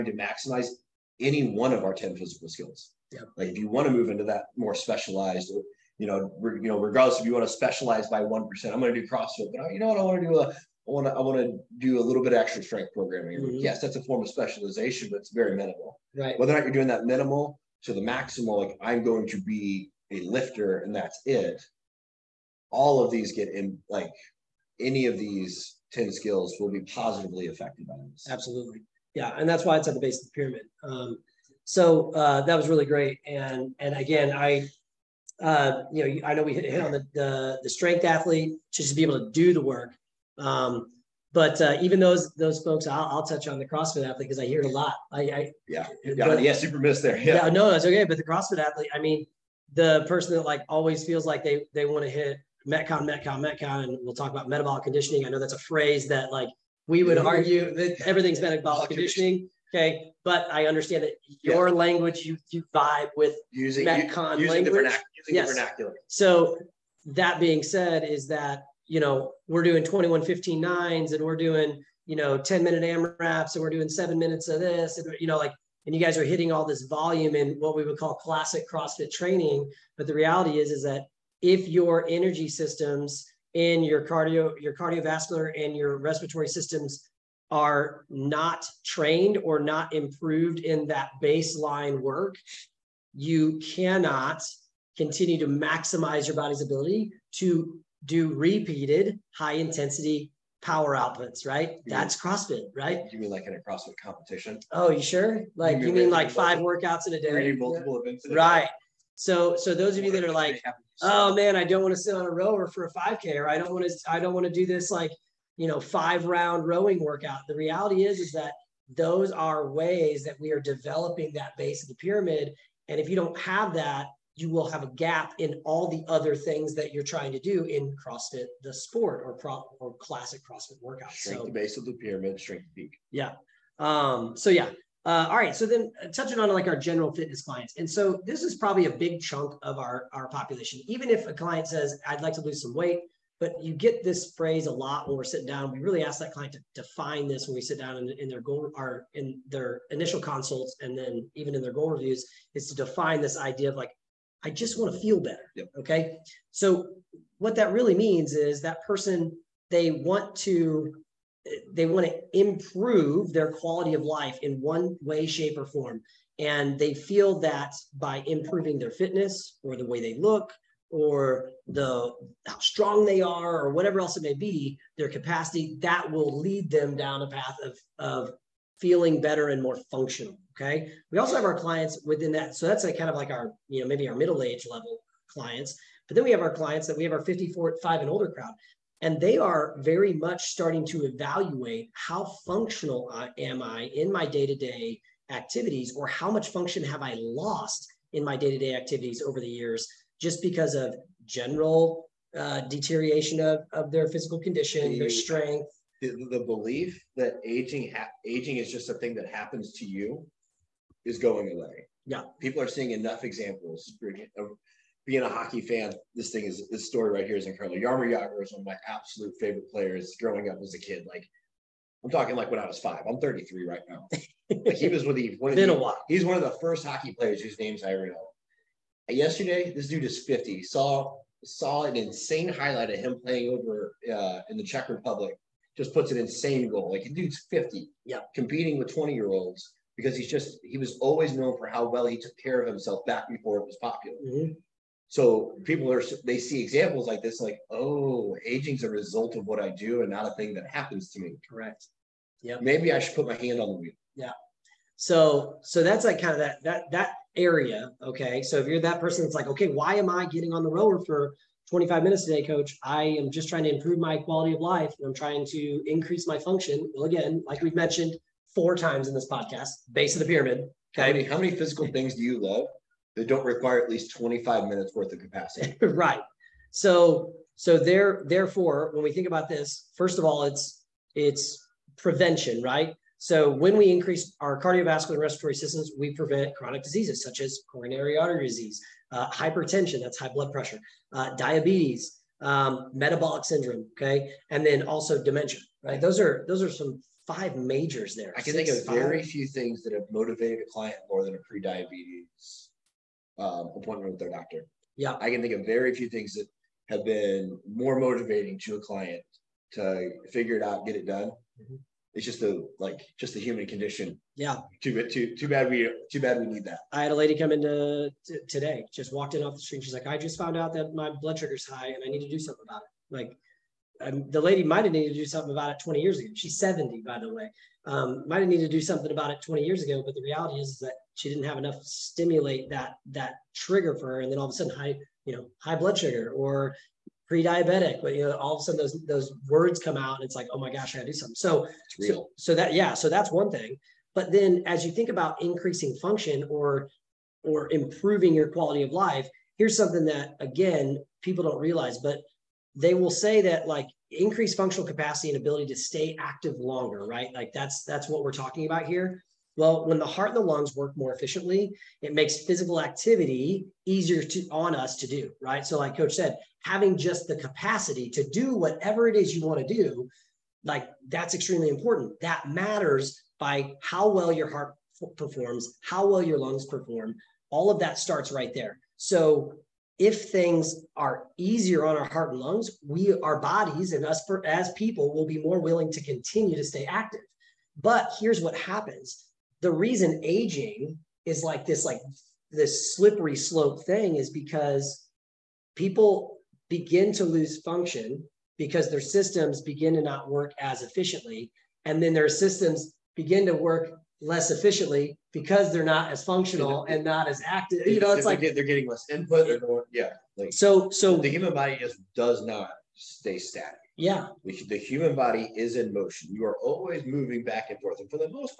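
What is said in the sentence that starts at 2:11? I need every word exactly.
Strength so, the base of the pyramid, strength the peak.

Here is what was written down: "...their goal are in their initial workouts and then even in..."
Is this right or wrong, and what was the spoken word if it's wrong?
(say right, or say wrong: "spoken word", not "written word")
wrong: "consults", not "workouts".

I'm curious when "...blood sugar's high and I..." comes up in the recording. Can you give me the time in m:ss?
5:21.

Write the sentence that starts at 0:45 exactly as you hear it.
I, I yeah, yeah, but, yeah, super miss there.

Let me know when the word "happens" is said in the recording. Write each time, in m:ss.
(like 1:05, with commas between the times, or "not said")
3:29, 4:10, 6:28.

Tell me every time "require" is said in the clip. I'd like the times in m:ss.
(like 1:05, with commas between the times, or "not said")
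4:33.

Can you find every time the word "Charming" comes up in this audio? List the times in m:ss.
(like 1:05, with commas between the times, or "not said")
not said.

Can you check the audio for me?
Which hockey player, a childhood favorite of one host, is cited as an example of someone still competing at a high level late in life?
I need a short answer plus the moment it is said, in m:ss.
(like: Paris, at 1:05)
Jaromir Jagr, at 3:37.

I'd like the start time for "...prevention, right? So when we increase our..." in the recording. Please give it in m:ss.
4:41.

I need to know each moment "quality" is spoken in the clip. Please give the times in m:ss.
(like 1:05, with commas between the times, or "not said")
2:43, 4:24, 5:48.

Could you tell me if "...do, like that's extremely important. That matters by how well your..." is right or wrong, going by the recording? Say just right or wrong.
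right.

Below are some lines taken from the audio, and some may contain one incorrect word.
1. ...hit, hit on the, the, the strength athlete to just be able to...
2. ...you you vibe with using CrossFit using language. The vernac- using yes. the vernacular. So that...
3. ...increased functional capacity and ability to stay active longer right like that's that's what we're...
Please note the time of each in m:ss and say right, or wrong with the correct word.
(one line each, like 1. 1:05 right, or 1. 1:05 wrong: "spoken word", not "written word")
1. 0:36 right
2. 1:02 wrong: "Metcon", not "CrossFit"
3. 5:54 right.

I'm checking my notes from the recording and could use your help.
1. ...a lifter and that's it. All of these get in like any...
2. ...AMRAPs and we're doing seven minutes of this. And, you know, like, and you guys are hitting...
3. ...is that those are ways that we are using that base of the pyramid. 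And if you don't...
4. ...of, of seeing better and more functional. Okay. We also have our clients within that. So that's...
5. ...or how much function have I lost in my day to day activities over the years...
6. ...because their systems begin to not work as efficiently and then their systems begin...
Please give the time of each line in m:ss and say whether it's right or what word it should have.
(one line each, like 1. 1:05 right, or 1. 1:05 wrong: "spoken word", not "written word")
1. 0:20 right
2. 1:12 right
3. 1:58 wrong: "developing", not "using"
4. 2:57 wrong: "feeling", not "seeing"
5. 3:15 right
6. 6:38 right.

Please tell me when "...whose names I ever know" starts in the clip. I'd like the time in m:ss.
3:47.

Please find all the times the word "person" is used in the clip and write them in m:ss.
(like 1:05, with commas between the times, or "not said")
0:50, 2:38, 4:18.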